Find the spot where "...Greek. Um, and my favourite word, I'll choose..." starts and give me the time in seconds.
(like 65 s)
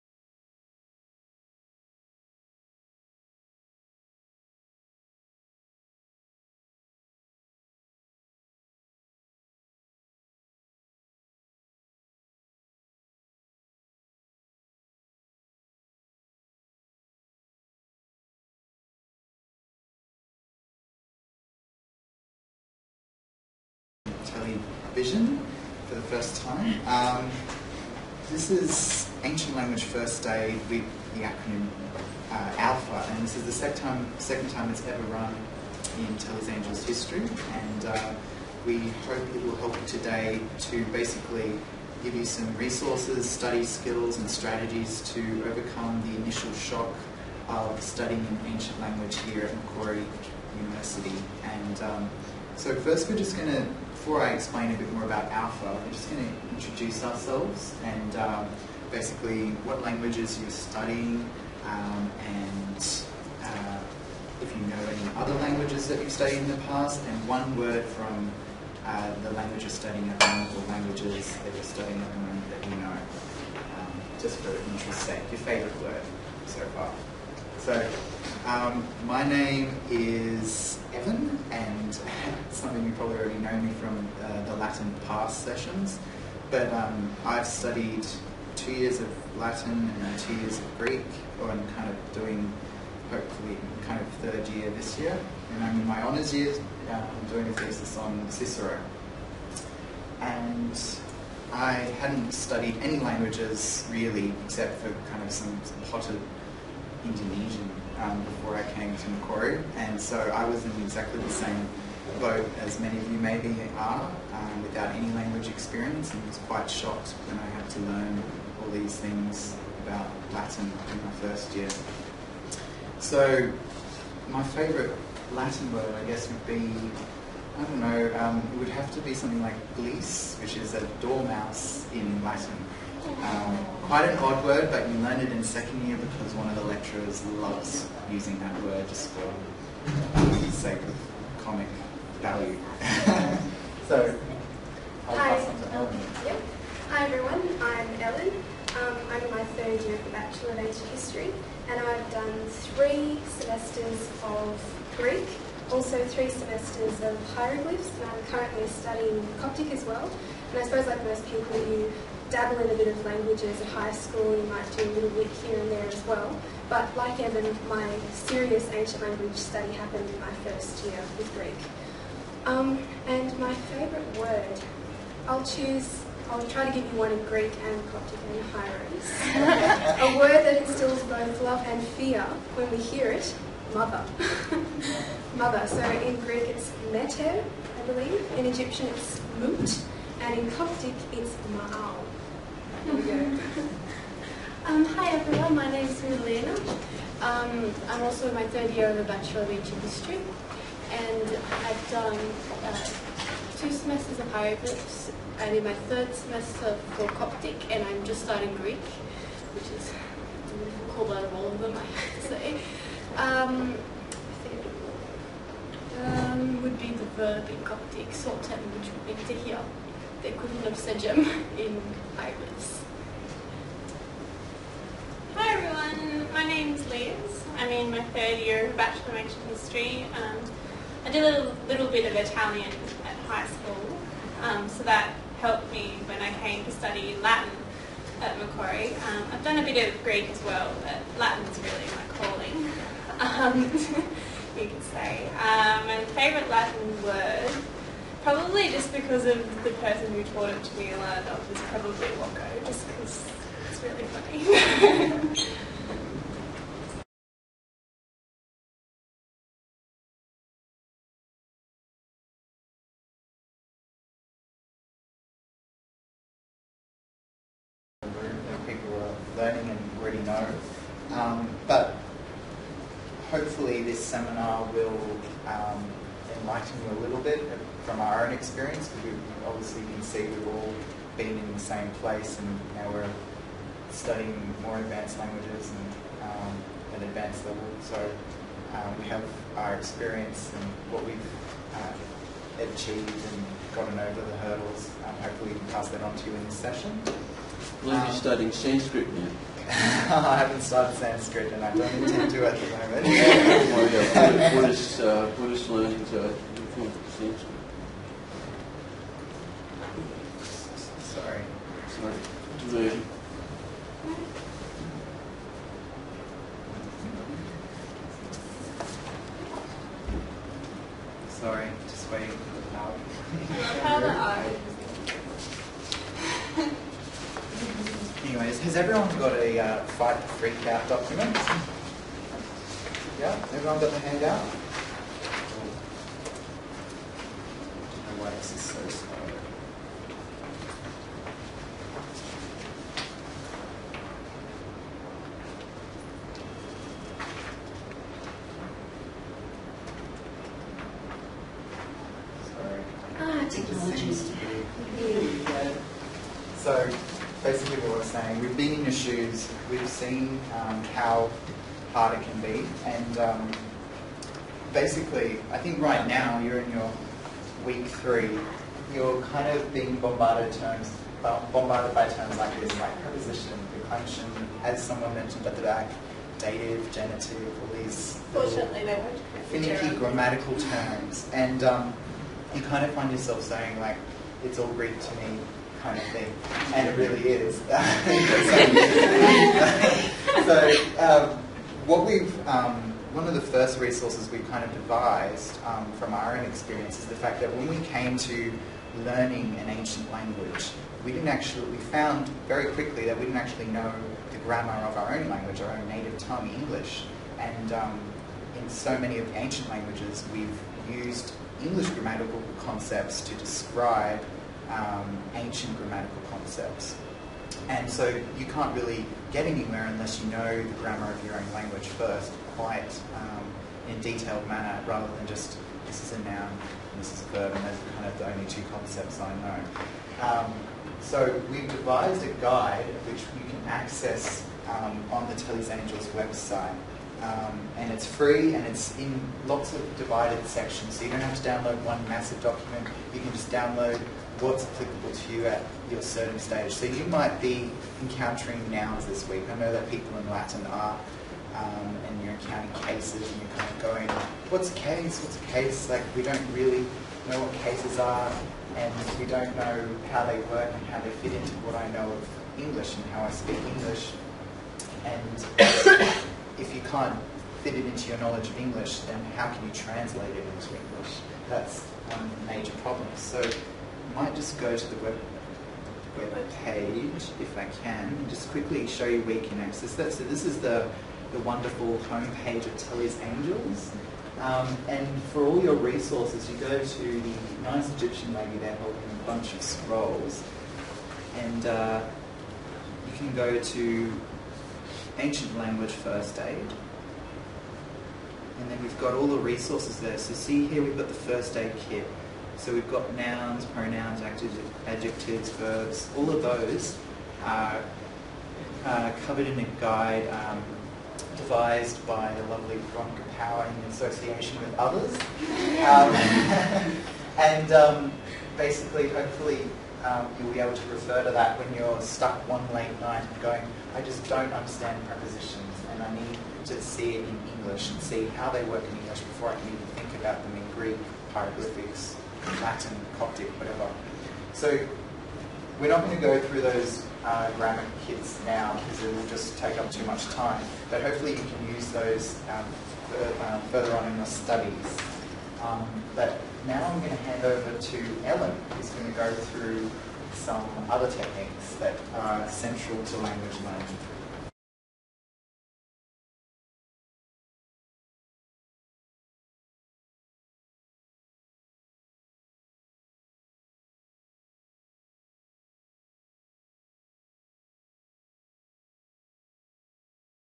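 171 s.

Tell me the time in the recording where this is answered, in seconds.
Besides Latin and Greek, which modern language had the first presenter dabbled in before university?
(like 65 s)
107 s.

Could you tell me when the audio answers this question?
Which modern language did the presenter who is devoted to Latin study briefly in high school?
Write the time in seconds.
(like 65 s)
232 s.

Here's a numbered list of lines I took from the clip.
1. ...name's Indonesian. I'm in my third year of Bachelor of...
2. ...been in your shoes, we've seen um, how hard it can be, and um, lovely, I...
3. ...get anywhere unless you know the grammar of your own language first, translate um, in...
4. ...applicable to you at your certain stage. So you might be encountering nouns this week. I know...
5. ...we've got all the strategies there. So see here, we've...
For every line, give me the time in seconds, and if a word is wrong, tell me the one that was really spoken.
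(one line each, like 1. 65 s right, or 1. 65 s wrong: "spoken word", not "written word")
1. 226 s wrong: "Liz", not "Indonesian"
2. 358 s wrong: "basically", not "lovely"
3. 419 s wrong: "quite", not "translate"
4. 444 s right
5. 498 s wrong: "resources", not "strategies".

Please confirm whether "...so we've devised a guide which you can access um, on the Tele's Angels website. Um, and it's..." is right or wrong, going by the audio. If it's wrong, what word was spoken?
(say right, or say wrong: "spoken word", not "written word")
right.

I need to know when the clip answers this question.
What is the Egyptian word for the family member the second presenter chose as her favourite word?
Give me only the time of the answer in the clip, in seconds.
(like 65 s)
189 s.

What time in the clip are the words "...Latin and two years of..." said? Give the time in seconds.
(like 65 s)
89 s.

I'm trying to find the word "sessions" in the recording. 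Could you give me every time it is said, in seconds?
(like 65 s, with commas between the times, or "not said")
85 s, 296 s.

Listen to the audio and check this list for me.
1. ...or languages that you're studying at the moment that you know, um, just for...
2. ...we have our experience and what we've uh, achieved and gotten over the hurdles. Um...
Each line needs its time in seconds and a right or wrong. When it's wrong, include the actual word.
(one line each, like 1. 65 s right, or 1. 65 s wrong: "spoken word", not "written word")
1. 70 s right
2. 289 s right.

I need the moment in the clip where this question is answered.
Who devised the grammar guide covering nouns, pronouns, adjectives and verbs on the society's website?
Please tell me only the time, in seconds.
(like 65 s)
512 s.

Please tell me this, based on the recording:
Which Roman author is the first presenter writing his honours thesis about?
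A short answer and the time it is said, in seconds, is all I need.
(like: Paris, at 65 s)
Cicero, at 98 s.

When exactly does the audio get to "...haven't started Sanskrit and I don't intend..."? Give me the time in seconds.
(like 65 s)
300 s.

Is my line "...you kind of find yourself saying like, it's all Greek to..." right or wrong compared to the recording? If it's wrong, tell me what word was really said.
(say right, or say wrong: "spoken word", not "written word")
right.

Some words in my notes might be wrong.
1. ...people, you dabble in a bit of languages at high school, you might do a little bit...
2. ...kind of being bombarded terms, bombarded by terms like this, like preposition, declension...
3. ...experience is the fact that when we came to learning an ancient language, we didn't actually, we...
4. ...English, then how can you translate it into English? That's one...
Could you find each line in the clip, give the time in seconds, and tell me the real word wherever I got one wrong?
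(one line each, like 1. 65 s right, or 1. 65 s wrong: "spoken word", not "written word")
1. 161 s right
2. 369 s right
3. 396 s right
4. 468 s right.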